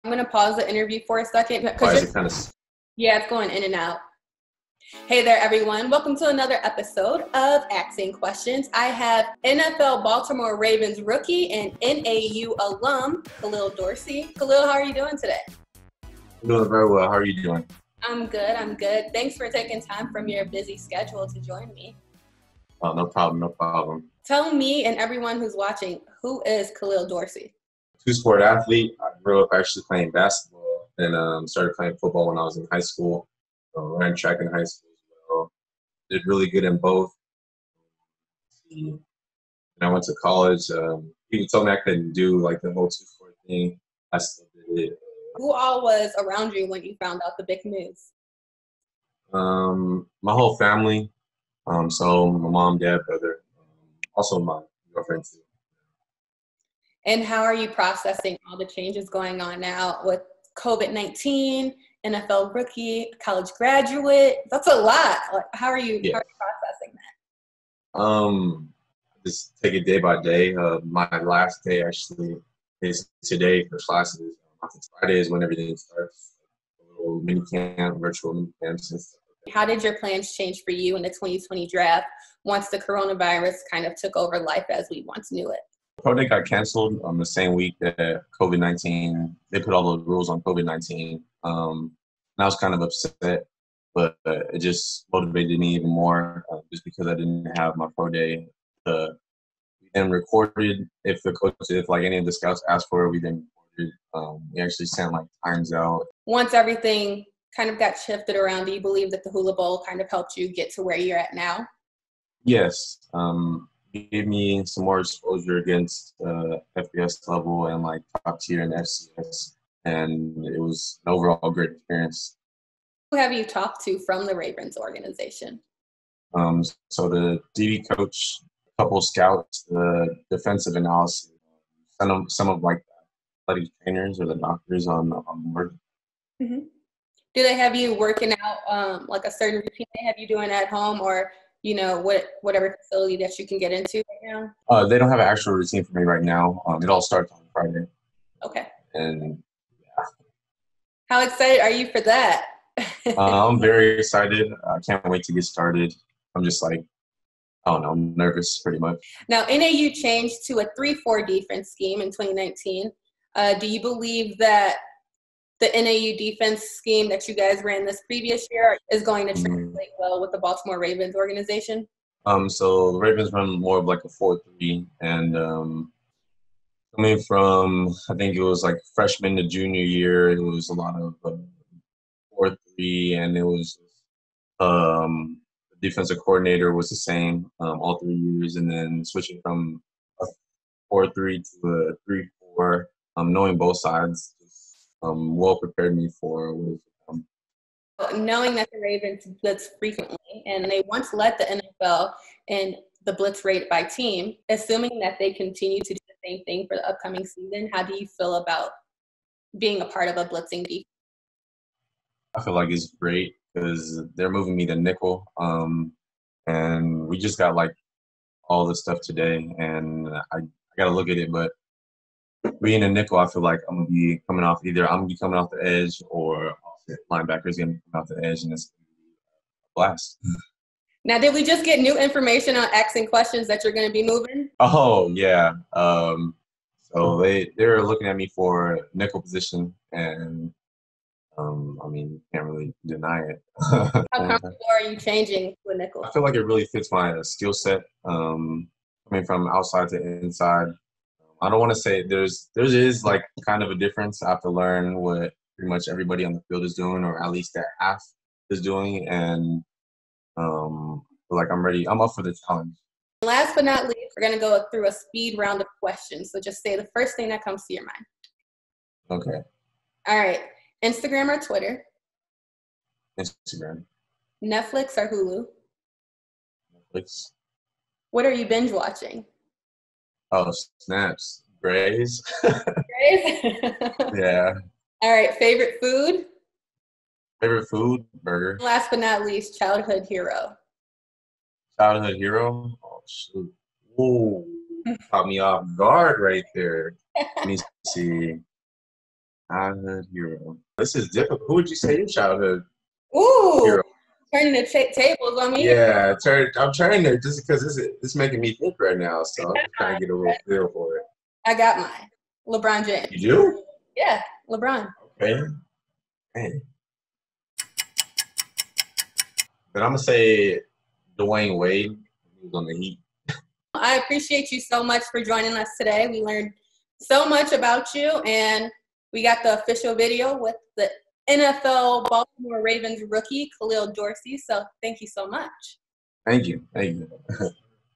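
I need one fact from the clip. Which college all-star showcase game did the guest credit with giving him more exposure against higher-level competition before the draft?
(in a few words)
Hula Bowl.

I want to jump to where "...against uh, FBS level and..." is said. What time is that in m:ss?
1:55.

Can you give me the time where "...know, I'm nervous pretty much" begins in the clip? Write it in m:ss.
2:37.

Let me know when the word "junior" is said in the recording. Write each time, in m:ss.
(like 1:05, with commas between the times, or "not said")
2:59.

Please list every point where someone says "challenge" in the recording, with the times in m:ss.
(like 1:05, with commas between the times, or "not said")
4:22.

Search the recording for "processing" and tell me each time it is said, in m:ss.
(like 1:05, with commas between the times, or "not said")
0:57, 1:06.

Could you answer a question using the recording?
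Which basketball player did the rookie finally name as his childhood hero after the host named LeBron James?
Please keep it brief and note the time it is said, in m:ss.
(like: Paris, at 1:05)
Dwyane Wade, at 5:21.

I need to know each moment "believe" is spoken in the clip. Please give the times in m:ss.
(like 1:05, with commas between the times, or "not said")
1:48, 2:43.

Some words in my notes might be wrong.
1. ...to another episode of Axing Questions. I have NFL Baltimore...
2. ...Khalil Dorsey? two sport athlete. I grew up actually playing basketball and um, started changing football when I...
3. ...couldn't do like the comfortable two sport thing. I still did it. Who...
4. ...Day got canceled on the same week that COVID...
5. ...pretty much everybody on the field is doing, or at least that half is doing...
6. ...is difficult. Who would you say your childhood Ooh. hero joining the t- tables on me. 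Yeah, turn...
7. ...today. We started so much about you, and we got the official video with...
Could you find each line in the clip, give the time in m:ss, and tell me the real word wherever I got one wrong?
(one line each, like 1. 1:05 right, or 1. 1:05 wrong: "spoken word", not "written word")
1. 0:06 right
2. 0:26 wrong: "playing", not "changing"
3. 0:41 wrong: "whole", not "comfortable"
4. 1:26 right
5. 4:15 right
6. 5:00 wrong: "turning", not "joining"
7. 5:25 wrong: "learned", not "started".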